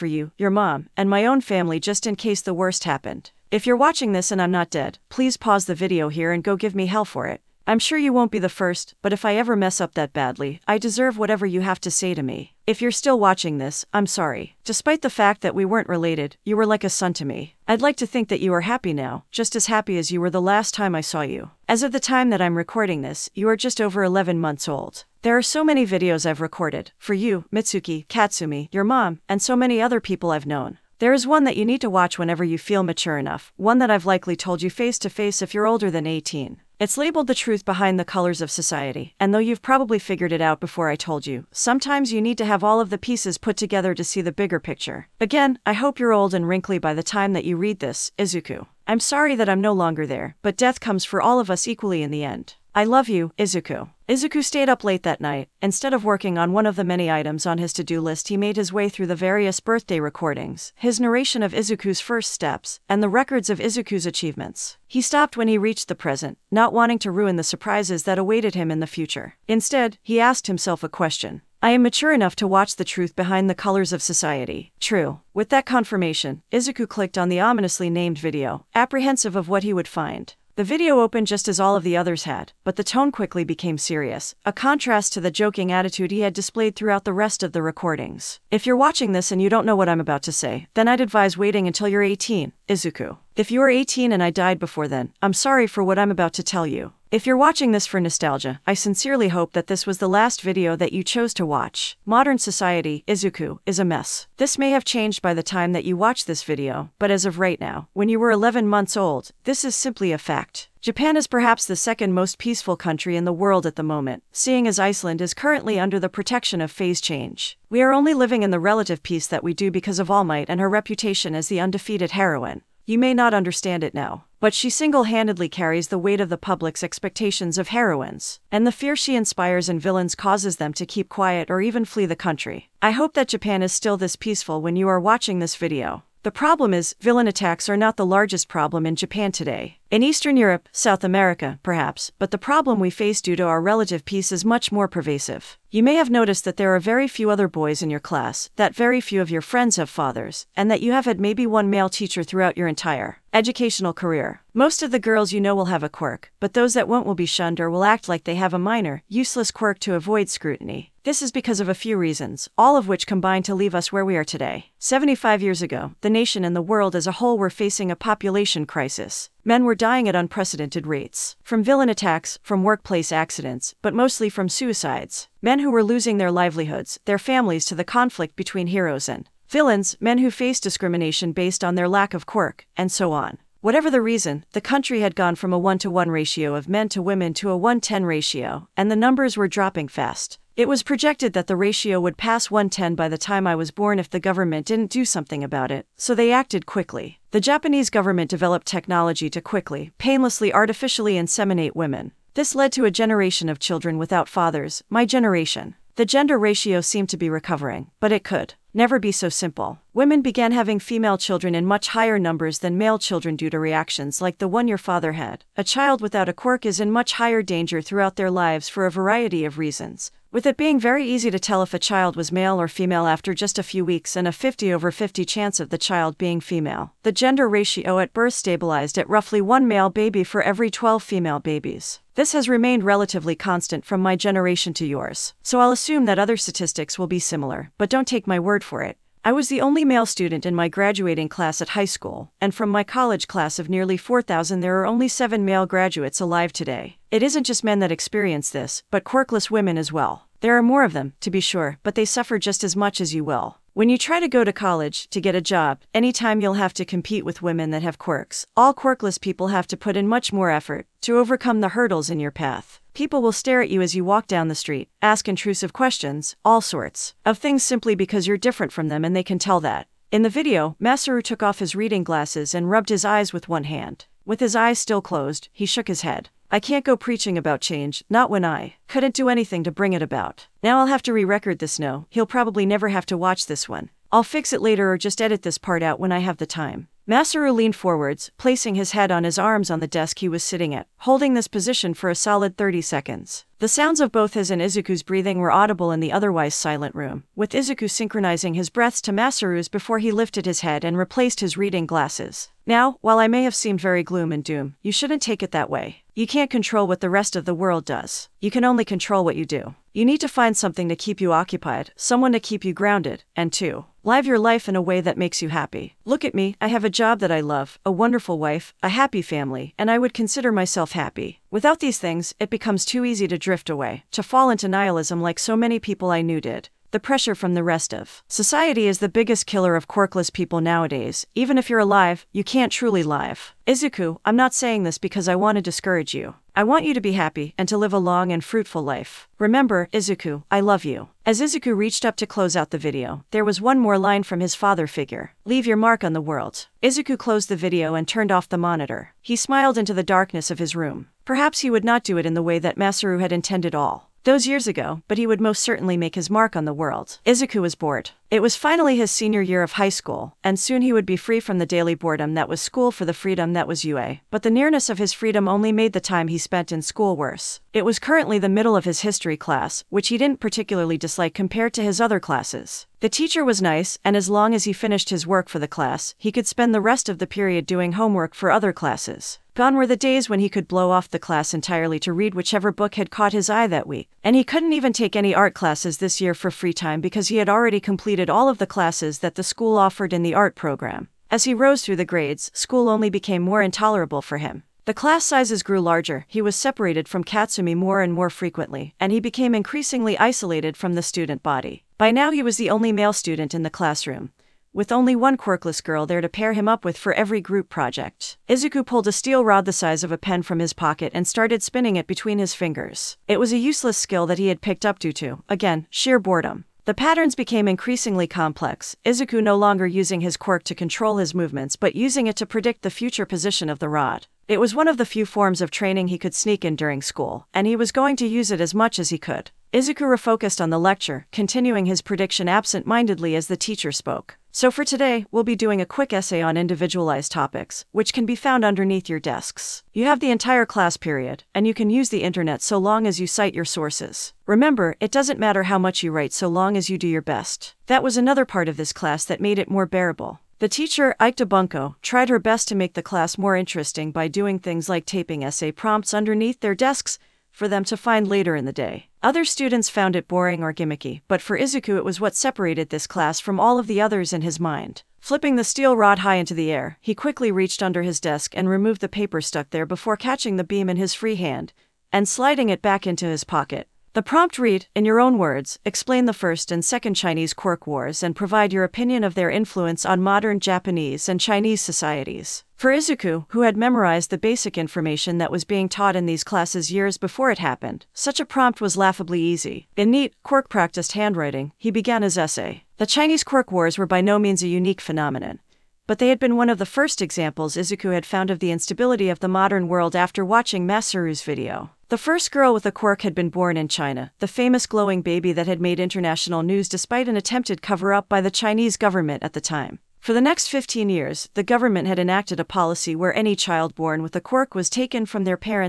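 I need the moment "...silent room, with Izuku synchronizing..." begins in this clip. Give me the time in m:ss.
4:56.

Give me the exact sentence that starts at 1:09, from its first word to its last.
Instead, he asked himself a question.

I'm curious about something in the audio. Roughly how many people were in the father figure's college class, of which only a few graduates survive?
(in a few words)
4,000.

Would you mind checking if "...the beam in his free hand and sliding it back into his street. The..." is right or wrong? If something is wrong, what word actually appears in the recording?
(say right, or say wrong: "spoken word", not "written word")
wrong: "pocket", not "street".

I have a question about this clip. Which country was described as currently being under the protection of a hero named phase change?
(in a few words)
Iceland.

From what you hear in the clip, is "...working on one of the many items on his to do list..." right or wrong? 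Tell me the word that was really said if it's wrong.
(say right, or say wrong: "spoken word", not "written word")
right.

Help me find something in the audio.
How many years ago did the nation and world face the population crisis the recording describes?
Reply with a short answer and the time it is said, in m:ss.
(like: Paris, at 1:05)
75, at 2:44.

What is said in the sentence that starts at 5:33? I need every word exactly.
Izuku, I'm not saying this because I want to discourage you.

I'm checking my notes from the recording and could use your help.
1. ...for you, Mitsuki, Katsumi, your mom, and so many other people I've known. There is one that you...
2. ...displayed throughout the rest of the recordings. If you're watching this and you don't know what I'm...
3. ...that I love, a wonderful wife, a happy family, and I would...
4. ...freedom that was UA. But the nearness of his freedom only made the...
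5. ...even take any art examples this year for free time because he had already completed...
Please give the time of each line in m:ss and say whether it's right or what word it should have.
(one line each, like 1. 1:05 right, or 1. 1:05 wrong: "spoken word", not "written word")
1. 0:26 right
2. 1:26 right
3. 5:17 right
4. 6:03 right
5. 6:24 wrong: "classes", not "examples".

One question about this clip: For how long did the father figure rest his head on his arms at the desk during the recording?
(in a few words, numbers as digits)
30 seconds.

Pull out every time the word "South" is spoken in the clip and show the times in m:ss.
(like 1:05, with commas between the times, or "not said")
2:20.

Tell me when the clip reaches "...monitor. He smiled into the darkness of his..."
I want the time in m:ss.
5:48.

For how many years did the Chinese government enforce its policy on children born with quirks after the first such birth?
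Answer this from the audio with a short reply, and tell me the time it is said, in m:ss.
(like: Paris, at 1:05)
15, at 8:30.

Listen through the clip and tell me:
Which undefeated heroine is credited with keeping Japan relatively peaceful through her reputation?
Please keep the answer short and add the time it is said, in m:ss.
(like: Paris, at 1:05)
All Might, at 2:00.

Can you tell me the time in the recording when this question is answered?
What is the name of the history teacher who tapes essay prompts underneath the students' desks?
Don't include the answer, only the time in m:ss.
7:31.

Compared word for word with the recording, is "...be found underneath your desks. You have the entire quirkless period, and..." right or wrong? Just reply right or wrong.
wrong.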